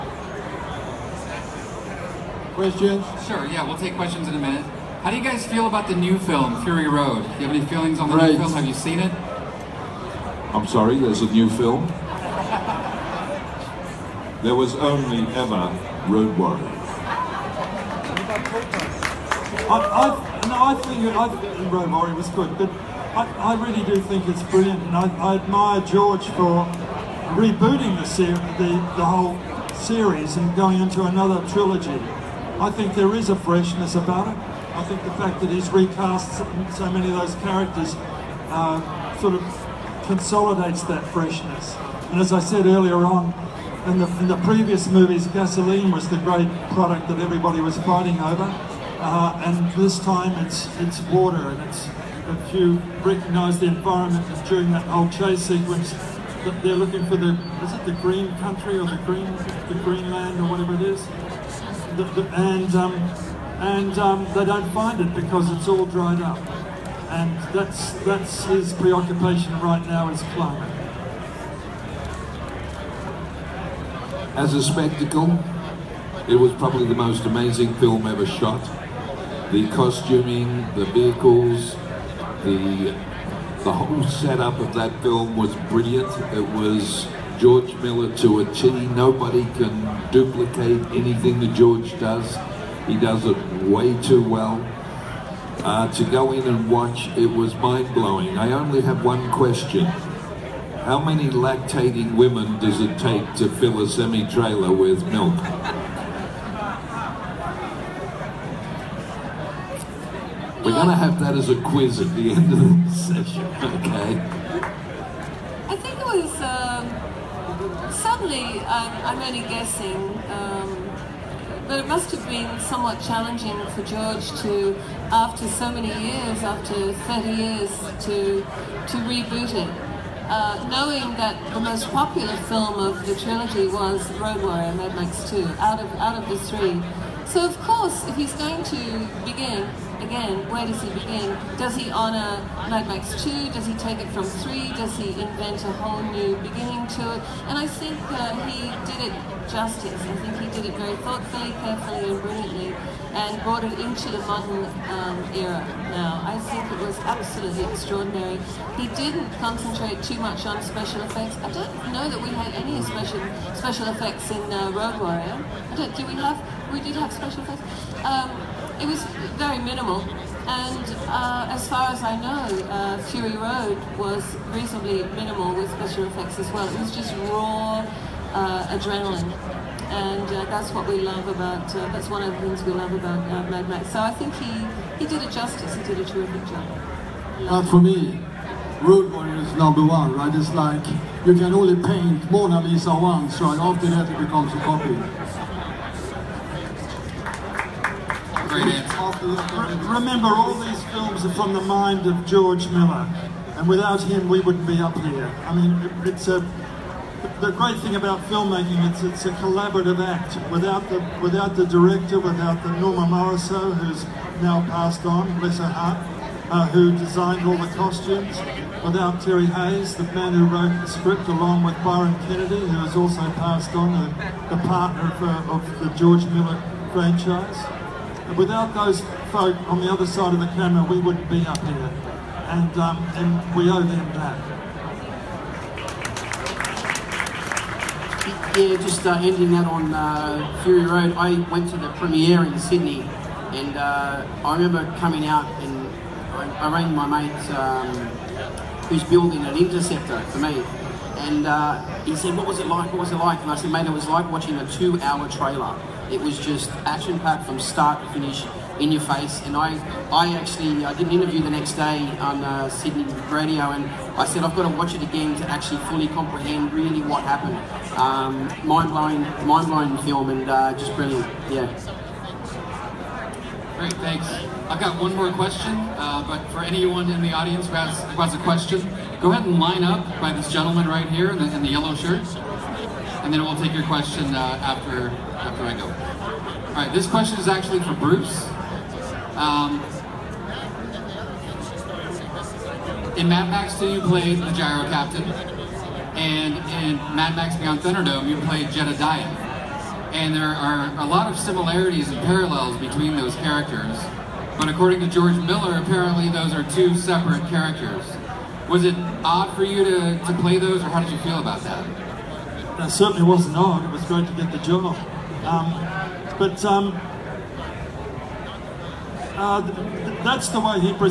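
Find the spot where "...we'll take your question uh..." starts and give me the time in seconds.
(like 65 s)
283 s.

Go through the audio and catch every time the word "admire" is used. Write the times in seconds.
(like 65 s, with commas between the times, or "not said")
25 s.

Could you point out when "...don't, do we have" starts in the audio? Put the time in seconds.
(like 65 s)
165 s.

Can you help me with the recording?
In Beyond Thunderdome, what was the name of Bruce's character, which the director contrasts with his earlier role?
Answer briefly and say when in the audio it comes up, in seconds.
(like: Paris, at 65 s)
Jedediah, at 298 s.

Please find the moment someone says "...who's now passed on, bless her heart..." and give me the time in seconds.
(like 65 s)
213 s.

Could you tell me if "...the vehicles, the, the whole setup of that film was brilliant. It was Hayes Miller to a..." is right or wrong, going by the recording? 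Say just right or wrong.
wrong.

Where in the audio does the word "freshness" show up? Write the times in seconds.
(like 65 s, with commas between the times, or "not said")
33 s, 41 s.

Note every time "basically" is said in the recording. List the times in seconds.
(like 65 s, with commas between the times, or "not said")
not said.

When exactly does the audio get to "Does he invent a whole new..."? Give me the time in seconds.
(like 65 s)
144 s.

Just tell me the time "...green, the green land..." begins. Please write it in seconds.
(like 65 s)
59 s.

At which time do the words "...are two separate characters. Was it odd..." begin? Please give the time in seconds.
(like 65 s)
306 s.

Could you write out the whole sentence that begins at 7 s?
Do you have any feelings on the right.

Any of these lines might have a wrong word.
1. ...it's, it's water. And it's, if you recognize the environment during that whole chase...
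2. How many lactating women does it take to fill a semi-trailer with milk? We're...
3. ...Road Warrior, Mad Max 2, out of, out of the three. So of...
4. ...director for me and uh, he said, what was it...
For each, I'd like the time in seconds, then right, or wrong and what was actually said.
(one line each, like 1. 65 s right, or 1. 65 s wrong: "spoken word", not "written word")
1. 50 s right
2. 100 s right
3. 134 s right
4. 249 s wrong: "interceptor", not "director".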